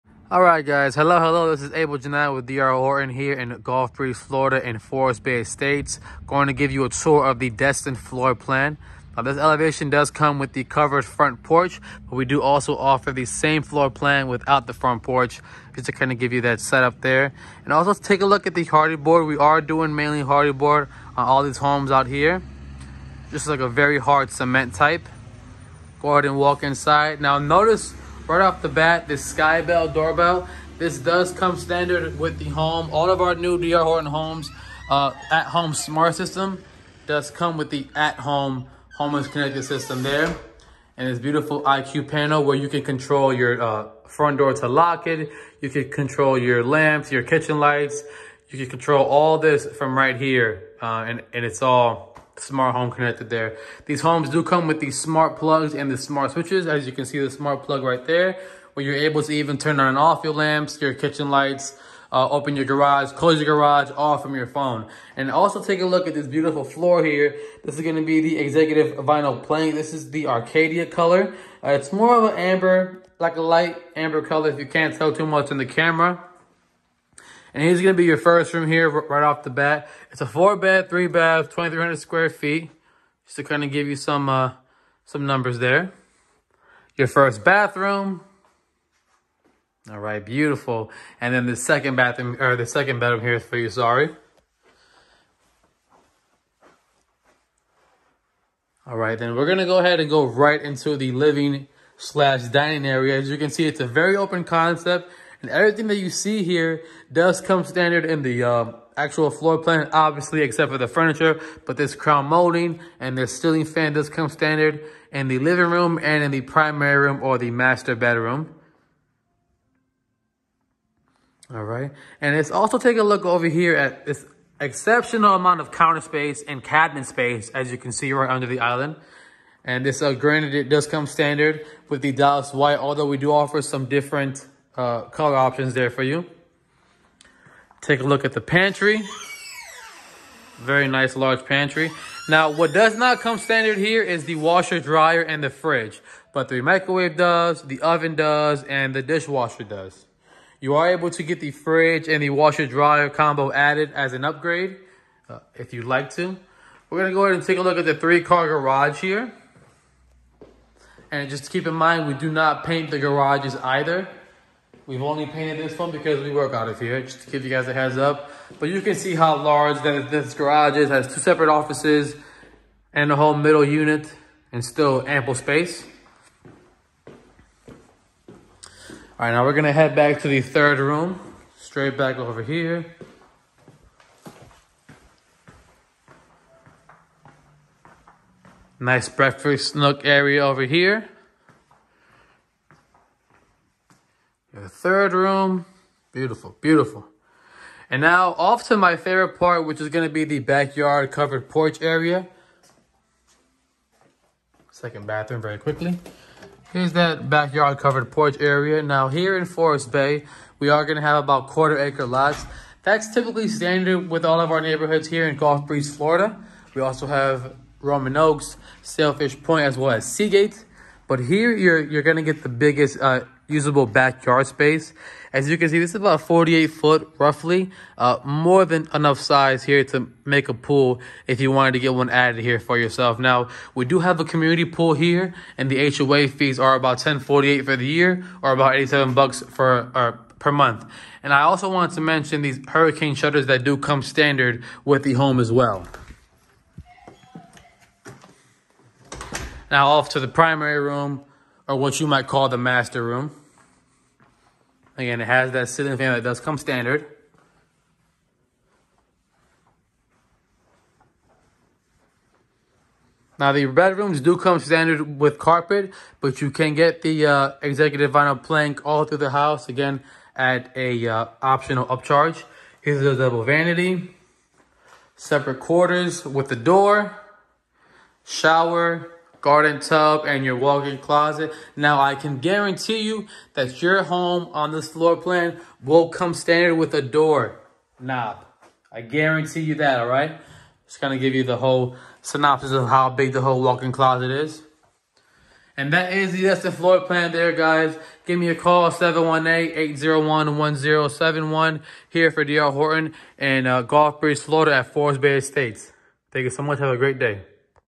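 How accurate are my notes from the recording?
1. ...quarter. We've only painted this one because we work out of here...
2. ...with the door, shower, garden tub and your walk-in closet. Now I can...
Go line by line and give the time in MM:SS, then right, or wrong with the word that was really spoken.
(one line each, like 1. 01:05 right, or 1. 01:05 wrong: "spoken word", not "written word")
1. 02:43 wrong: "either", not "quarter"
2. 04:36 right.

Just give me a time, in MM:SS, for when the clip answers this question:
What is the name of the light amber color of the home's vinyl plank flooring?
01:10.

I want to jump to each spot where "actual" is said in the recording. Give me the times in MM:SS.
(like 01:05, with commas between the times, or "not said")
01:48.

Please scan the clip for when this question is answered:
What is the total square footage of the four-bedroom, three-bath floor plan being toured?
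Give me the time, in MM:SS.
01:21.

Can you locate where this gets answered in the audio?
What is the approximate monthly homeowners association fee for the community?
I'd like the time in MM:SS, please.
03:58.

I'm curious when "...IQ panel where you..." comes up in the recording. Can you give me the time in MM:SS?
00:41.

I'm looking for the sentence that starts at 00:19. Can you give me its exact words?
We are doing mainly Hardie board on all these homes out here.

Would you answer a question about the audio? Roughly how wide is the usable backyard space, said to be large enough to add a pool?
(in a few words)
48 foot.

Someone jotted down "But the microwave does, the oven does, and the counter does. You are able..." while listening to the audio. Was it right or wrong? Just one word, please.
wrong.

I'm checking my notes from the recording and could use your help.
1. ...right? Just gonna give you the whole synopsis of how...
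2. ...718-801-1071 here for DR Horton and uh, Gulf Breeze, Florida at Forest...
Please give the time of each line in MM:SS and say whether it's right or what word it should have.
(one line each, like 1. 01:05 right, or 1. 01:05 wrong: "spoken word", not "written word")
1. 04:50 right
2. 04:58 right.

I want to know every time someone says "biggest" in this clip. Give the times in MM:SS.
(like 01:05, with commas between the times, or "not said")
03:42.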